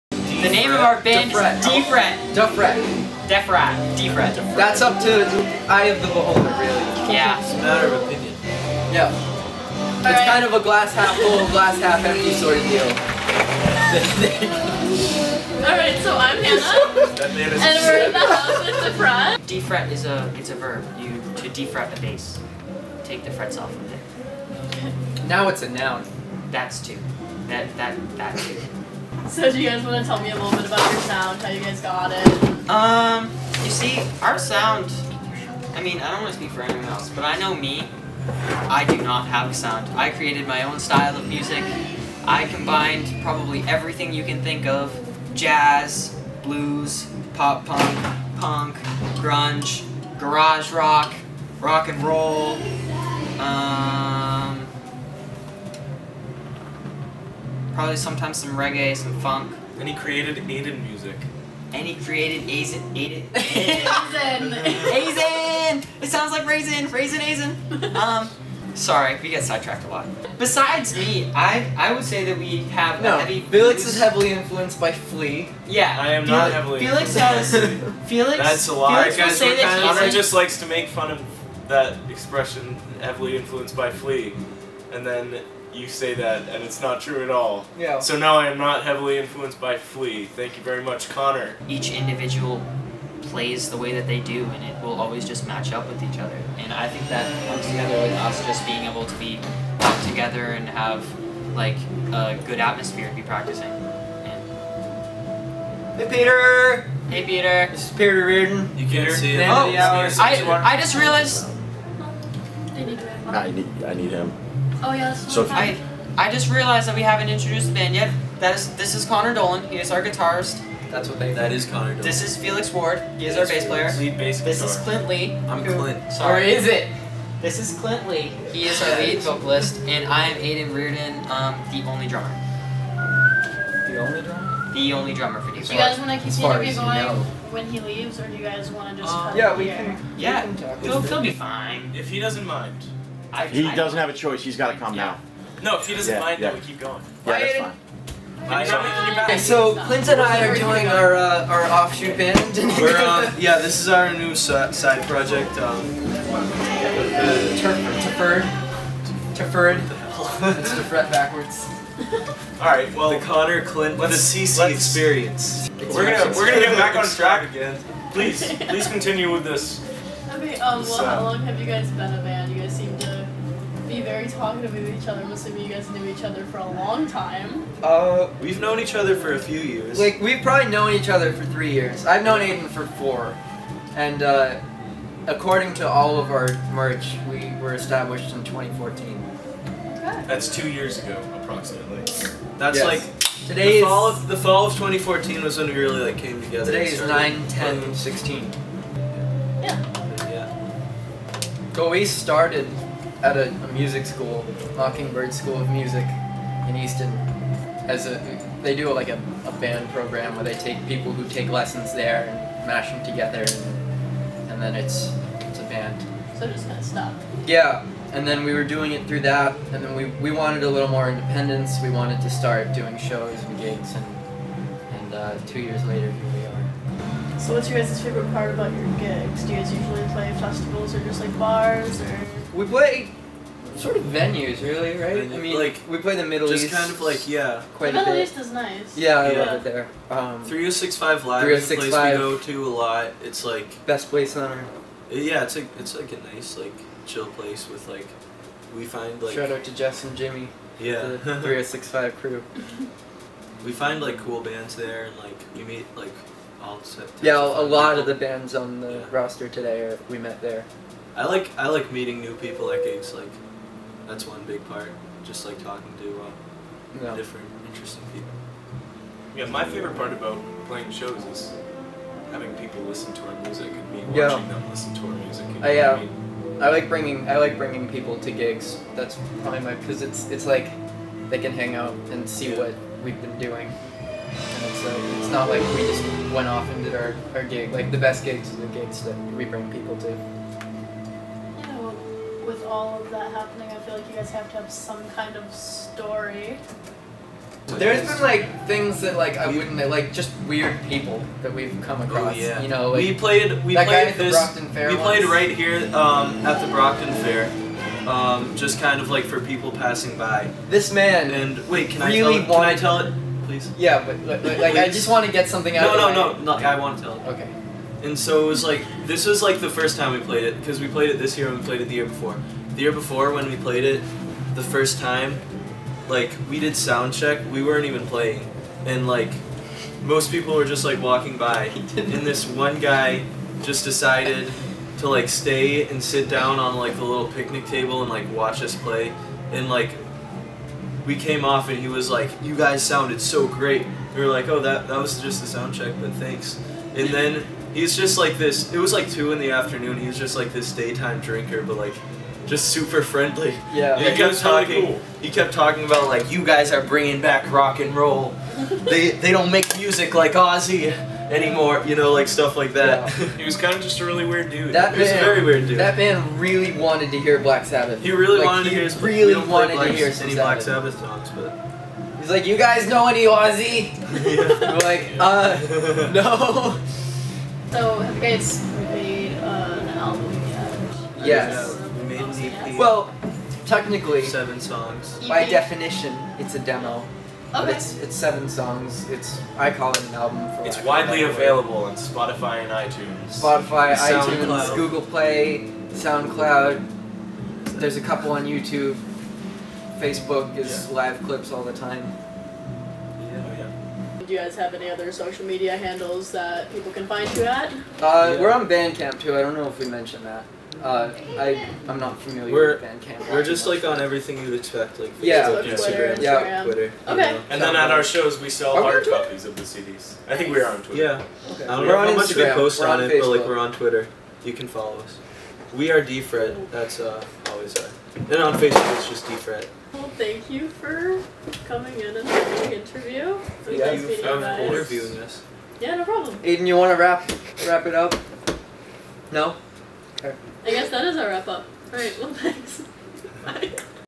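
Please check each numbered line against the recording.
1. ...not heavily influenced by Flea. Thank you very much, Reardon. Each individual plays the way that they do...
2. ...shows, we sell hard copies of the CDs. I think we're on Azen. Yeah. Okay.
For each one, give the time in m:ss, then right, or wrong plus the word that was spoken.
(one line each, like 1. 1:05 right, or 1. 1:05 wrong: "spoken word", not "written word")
1. 1:28 wrong: "Connor", not "Reardon"
2. 6:58 wrong: "Twitter", not "Azen".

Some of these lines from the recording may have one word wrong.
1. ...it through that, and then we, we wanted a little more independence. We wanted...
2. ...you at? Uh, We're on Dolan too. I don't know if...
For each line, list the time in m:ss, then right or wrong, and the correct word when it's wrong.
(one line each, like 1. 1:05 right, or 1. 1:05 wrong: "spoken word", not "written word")
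1. 3:38 right
2. 6:47 wrong: "Bandcamp", not "Dolan".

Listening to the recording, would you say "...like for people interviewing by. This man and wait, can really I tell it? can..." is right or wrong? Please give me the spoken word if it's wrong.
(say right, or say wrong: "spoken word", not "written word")
wrong: "passing", not "interviewing".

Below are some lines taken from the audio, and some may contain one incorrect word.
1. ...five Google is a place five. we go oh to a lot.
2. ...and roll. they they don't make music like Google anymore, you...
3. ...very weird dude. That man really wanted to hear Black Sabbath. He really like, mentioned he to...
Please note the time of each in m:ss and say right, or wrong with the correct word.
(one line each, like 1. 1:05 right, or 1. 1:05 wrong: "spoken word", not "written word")
1. 4:00 wrong: "Live", not "Google"
2. 5:57 wrong: "Ozzy", not "Google"
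3. 6:05 wrong: "wanted", not "mentioned".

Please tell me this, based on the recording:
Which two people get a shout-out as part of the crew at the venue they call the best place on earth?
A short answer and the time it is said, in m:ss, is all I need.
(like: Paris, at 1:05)
Jess and Jimmy, at 4:09.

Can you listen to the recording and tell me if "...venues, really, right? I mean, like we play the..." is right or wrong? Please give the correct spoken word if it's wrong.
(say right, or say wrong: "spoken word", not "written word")
right.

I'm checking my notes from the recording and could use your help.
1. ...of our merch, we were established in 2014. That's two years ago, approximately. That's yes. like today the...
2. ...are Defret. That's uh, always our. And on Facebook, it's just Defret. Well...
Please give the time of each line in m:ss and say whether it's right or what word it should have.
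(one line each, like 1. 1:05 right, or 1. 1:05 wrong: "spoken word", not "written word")
1. 3:06 right
2. 7:05 right.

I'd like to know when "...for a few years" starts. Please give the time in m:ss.
2:59.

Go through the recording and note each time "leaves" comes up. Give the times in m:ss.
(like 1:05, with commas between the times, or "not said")
2:17.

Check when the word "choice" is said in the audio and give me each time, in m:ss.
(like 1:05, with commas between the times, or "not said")
2:24.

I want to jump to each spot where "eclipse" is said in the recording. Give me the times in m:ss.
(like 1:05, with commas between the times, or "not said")
not said.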